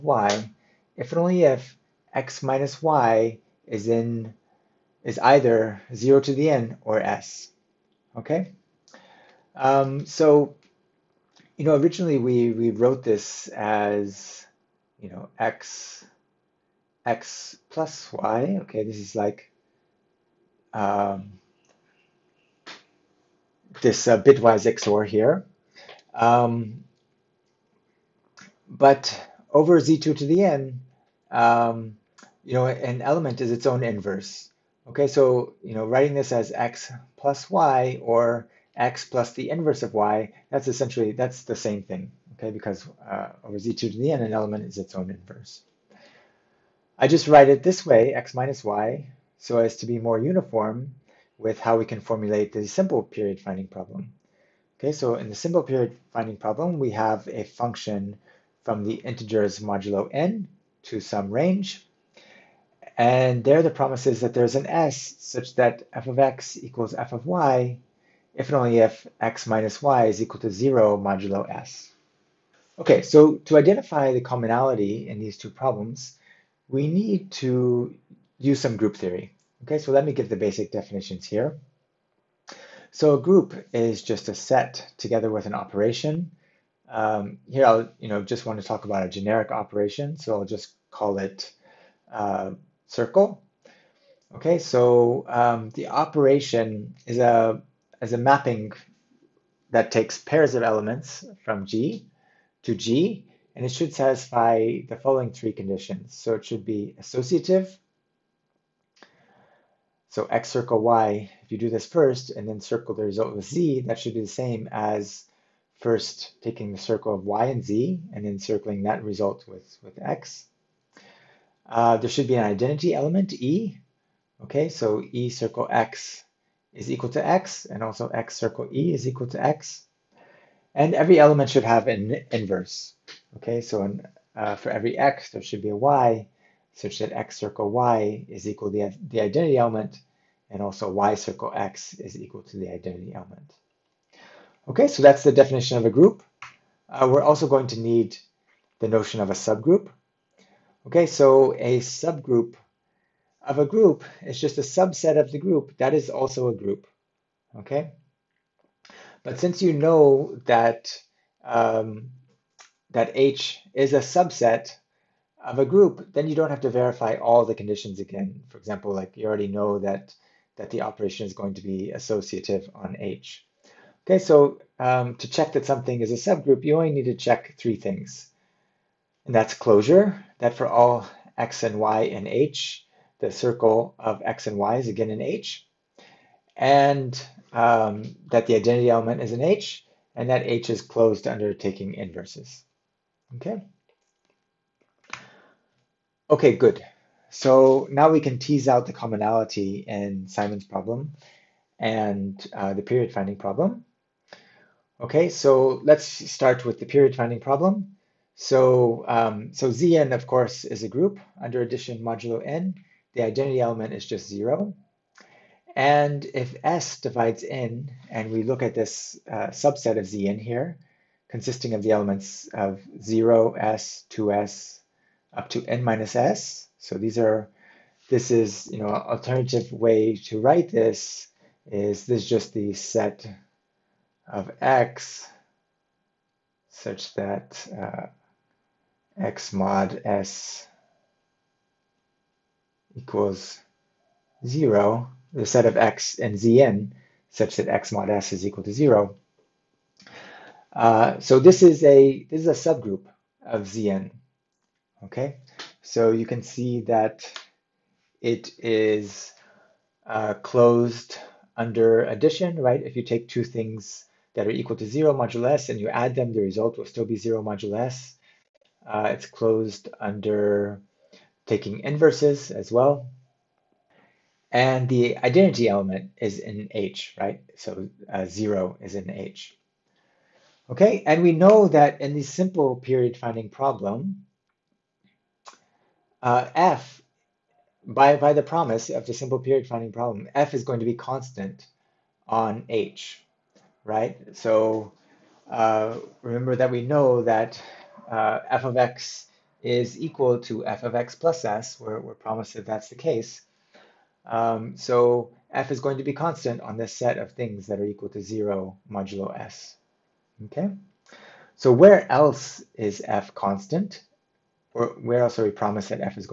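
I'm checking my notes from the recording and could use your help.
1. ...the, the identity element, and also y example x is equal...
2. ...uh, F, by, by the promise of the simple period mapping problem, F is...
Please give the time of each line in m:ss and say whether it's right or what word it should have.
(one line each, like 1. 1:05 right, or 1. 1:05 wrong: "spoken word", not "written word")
1. 2:18 wrong: "circle", not "example"
2. 4:46 wrong: "finding", not "mapping".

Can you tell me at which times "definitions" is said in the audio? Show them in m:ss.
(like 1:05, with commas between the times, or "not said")
1:20, 2:25.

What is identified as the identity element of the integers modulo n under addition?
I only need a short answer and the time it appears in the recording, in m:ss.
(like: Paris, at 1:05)
zero, at 3:34.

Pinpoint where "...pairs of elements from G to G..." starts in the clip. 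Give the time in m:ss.
1:40.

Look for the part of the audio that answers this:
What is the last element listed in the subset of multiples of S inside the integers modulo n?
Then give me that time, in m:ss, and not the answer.
3:45.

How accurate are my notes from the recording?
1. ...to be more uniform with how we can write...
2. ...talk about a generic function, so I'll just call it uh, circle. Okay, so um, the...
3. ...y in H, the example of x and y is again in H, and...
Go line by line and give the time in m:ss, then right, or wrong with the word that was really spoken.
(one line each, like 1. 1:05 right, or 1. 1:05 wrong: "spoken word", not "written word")
1. 0:49 wrong: "formulate", not "write"
2. 1:28 wrong: "operation", not "function"
3. 3:01 wrong: "circle", not "example".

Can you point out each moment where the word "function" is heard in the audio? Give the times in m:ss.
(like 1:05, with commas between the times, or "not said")
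0:57.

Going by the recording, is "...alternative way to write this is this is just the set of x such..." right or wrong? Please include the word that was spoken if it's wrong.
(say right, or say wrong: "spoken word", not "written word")
right.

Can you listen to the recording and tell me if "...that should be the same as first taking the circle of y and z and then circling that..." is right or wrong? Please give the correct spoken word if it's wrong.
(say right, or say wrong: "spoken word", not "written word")
right.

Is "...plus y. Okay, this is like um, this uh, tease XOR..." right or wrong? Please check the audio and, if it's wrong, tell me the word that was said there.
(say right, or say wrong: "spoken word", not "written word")
wrong: "bitwise", not "tease".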